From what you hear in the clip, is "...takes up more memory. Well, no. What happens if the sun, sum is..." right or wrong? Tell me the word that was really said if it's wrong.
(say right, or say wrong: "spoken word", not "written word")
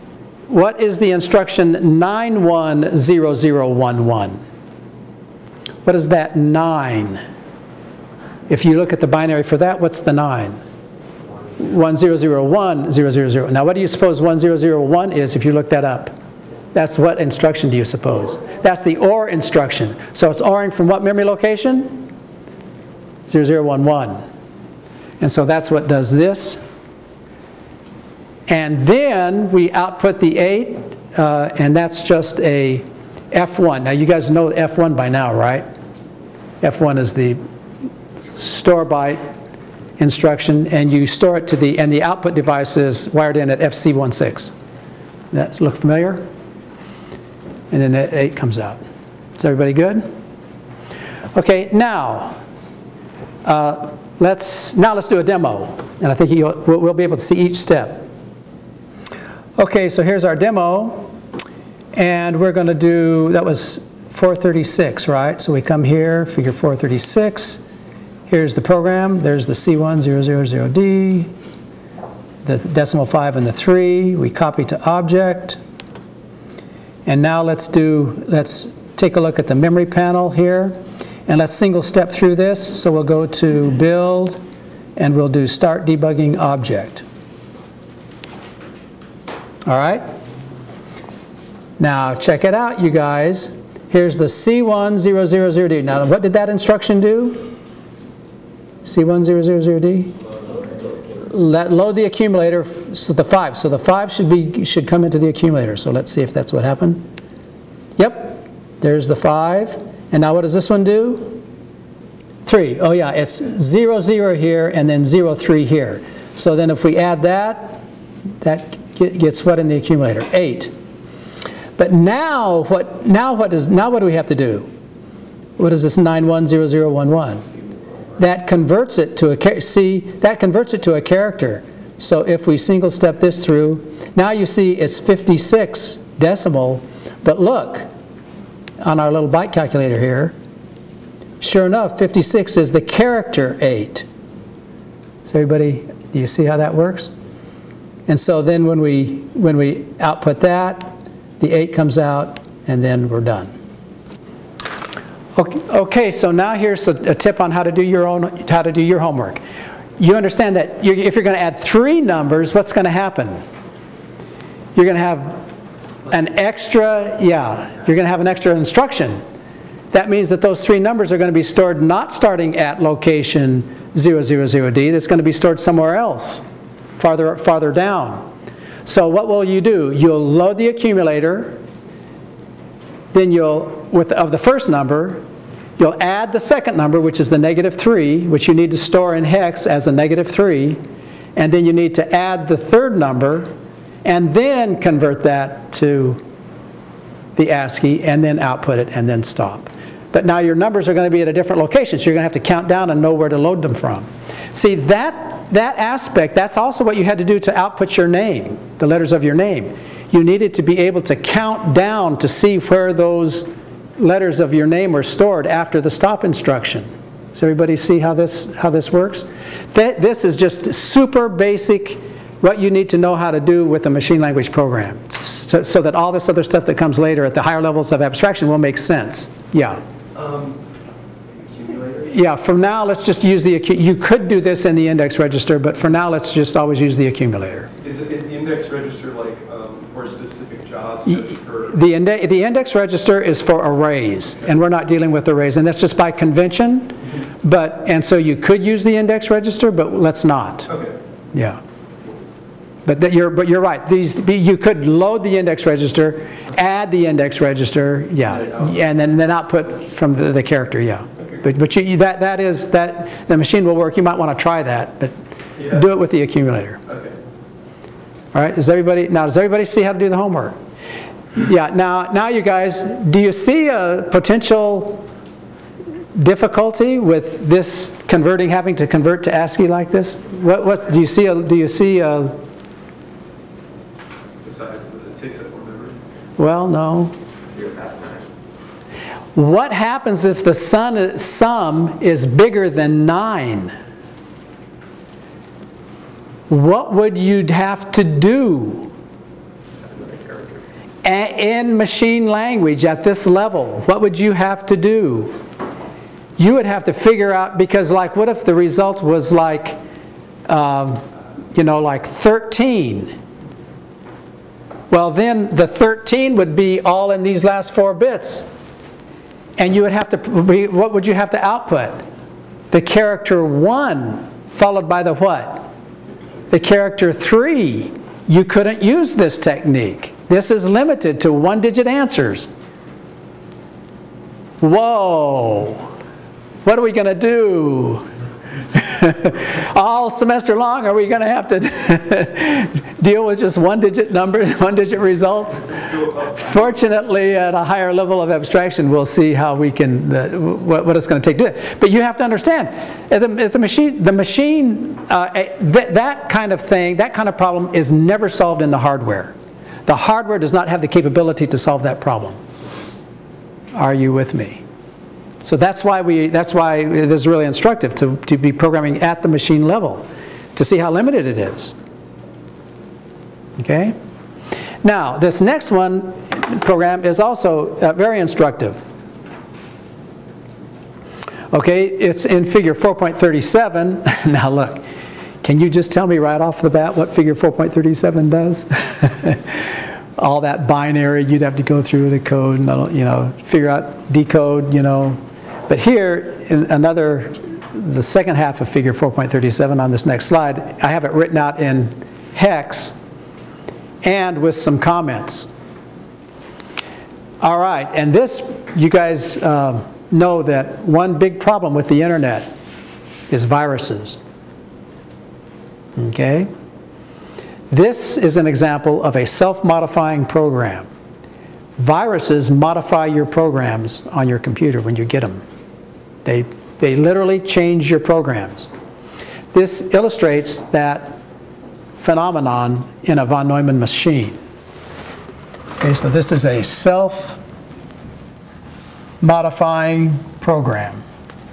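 right.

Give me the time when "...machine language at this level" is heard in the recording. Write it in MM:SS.
05:01.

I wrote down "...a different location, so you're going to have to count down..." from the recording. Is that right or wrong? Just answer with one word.
right.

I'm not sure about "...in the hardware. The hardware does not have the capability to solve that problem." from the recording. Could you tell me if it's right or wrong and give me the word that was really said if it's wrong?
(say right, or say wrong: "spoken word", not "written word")
right.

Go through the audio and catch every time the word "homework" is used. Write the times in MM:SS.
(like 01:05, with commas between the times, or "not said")
02:38, 04:30.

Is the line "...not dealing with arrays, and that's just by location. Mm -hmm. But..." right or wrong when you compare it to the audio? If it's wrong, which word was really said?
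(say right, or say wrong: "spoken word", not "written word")
wrong: "convention", not "location".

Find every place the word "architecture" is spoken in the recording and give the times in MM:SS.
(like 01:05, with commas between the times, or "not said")
not said.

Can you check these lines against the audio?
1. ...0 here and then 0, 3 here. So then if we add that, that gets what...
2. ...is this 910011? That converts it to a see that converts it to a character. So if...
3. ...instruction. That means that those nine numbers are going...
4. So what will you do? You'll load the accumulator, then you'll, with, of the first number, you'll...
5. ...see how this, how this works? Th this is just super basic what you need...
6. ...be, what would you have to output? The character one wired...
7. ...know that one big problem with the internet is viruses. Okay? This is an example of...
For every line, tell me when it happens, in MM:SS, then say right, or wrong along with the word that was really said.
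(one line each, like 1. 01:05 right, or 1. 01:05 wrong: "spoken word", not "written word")
1. 01:54 right
2. 02:05 right
3. 02:48 wrong: "three", not "nine"
4. 02:58 right
5. 03:37 right
6. 05:20 wrong: "followed", not "wired"
7. 06:50 right.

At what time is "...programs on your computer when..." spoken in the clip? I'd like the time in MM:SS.
07:03.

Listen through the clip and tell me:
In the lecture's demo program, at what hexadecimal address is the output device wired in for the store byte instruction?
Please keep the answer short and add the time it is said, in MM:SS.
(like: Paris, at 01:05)
FC16, at 00:43.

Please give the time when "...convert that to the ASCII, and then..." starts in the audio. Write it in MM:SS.
03:14.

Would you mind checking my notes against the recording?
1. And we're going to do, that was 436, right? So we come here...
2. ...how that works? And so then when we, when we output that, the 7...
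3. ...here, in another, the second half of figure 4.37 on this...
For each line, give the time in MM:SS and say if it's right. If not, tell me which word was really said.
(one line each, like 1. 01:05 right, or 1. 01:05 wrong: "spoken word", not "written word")
1. 01:01 right
2. 02:26 wrong: "8", not "7"
3. 06:35 right.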